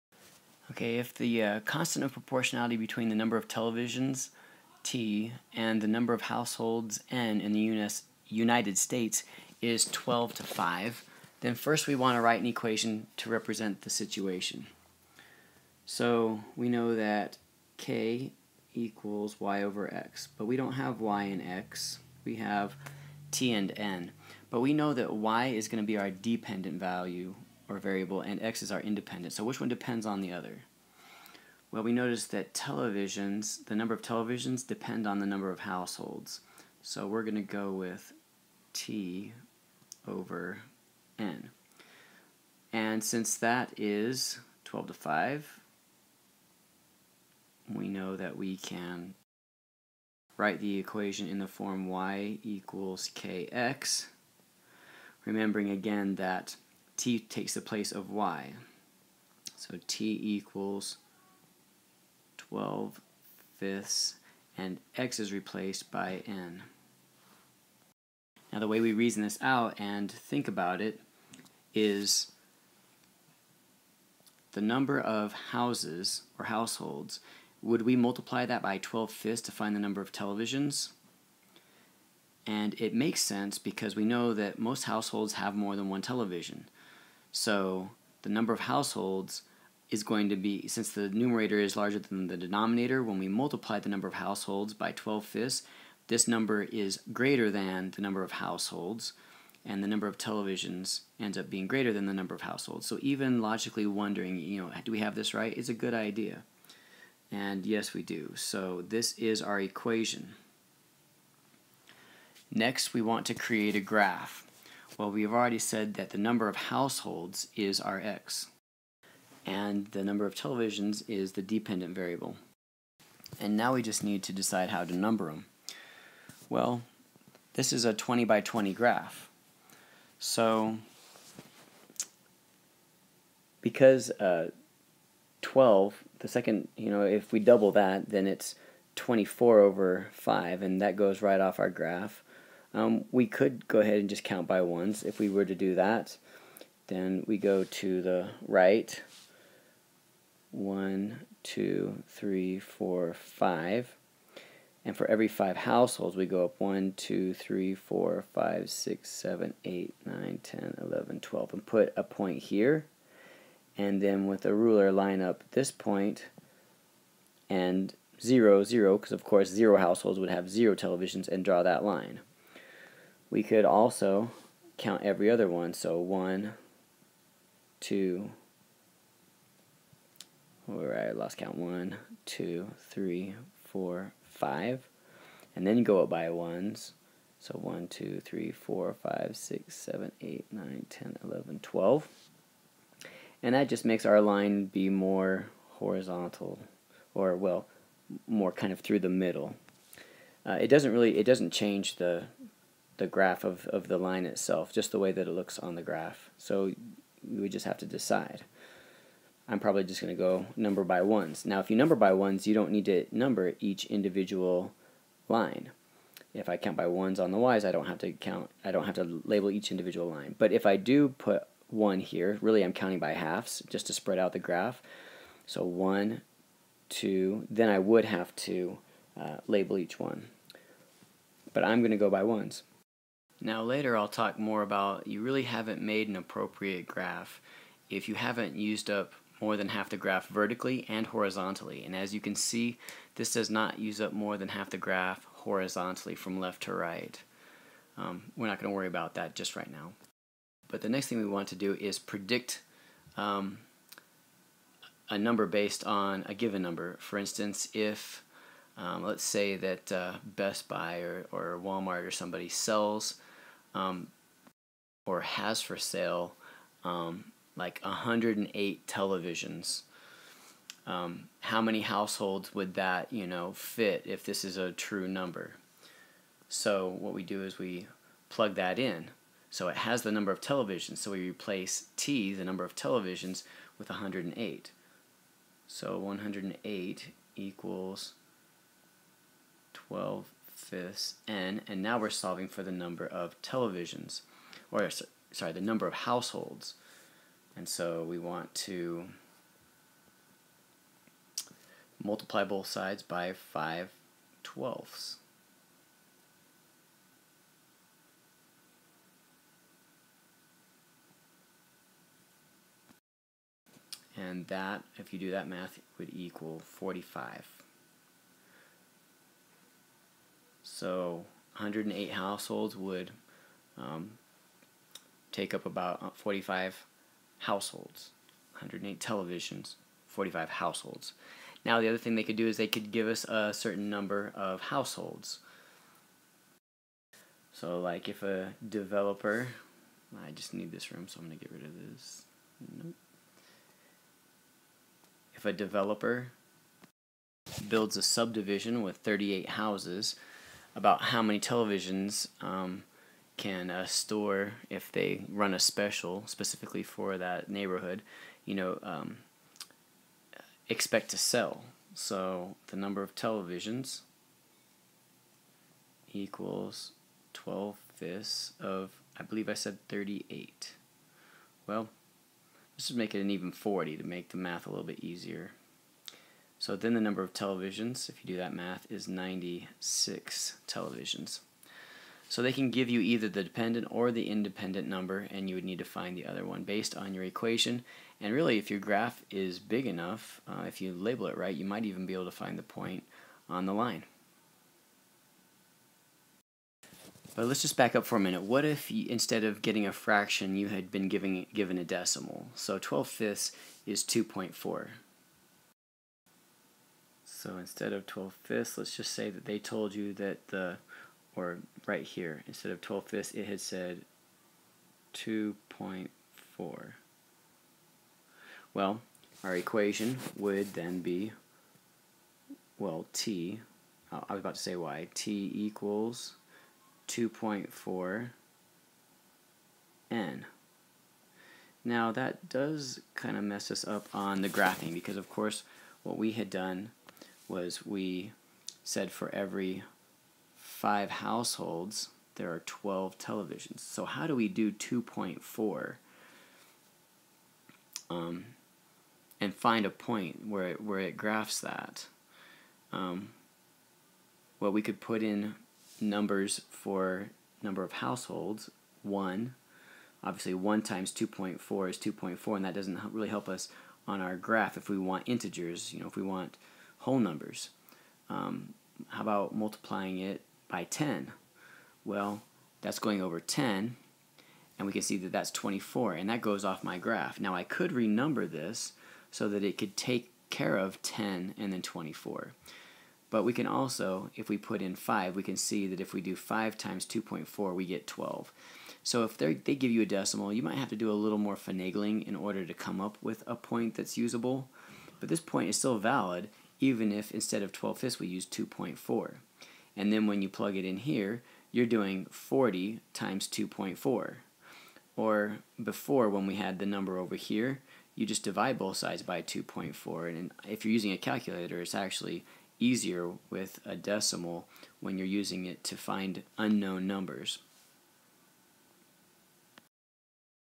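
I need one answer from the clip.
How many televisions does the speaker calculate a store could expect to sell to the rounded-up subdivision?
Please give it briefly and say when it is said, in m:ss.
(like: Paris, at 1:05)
96, at 6:19.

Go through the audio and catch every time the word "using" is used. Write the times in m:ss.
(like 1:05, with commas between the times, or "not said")
8:30, 8:35.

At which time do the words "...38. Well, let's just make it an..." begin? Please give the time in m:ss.
6:09.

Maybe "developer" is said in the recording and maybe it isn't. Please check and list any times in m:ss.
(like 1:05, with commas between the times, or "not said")
5:38, 5:45.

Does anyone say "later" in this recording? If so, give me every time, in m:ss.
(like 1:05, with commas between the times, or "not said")
3:53.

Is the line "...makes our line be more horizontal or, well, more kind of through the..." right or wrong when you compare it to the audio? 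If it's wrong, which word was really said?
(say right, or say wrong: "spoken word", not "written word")
right.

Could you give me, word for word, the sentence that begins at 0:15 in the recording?
So we know that K equals y over x, but we don't have y and x, we have t and n.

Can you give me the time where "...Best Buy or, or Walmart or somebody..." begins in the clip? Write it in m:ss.
4:20.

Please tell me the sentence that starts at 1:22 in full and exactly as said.
And it makes sense because we know that most households have more than one television.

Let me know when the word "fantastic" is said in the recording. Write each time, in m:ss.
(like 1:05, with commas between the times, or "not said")
not said.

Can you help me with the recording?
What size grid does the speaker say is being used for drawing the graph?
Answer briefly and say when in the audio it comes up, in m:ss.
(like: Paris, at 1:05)
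20 by 20, at 2:07.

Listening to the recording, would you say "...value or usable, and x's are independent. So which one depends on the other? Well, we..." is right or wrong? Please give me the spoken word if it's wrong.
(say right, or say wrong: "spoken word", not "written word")
wrong: "variable", not "usable".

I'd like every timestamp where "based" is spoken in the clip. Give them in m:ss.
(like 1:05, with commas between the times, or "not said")
4:15, 6:26.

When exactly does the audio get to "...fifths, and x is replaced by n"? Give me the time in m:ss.
1:03.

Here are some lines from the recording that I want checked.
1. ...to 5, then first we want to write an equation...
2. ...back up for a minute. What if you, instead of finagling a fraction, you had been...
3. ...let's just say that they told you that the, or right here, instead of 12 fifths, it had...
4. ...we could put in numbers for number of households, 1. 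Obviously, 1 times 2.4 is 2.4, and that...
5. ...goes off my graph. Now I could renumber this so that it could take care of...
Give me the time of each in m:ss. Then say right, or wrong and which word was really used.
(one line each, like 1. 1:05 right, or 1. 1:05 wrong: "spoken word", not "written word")
1. 0:10 right
2. 6:37 wrong: "getting", not "finagling"
3. 6:48 right
4. 7:34 right
5. 7:56 right.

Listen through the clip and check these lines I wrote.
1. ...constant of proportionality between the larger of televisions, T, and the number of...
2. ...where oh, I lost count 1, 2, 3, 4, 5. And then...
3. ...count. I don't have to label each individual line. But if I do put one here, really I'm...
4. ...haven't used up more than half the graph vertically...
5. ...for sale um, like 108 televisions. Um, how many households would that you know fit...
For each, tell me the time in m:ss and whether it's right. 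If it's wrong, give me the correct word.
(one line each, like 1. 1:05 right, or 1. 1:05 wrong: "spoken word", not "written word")
1. 0:01 wrong: "number", not "larger"
2. 3:00 right
3. 3:38 right
4. 3:58 right
5. 4:25 right.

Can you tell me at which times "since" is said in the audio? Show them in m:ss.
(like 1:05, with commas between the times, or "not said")
0:43, 1:30.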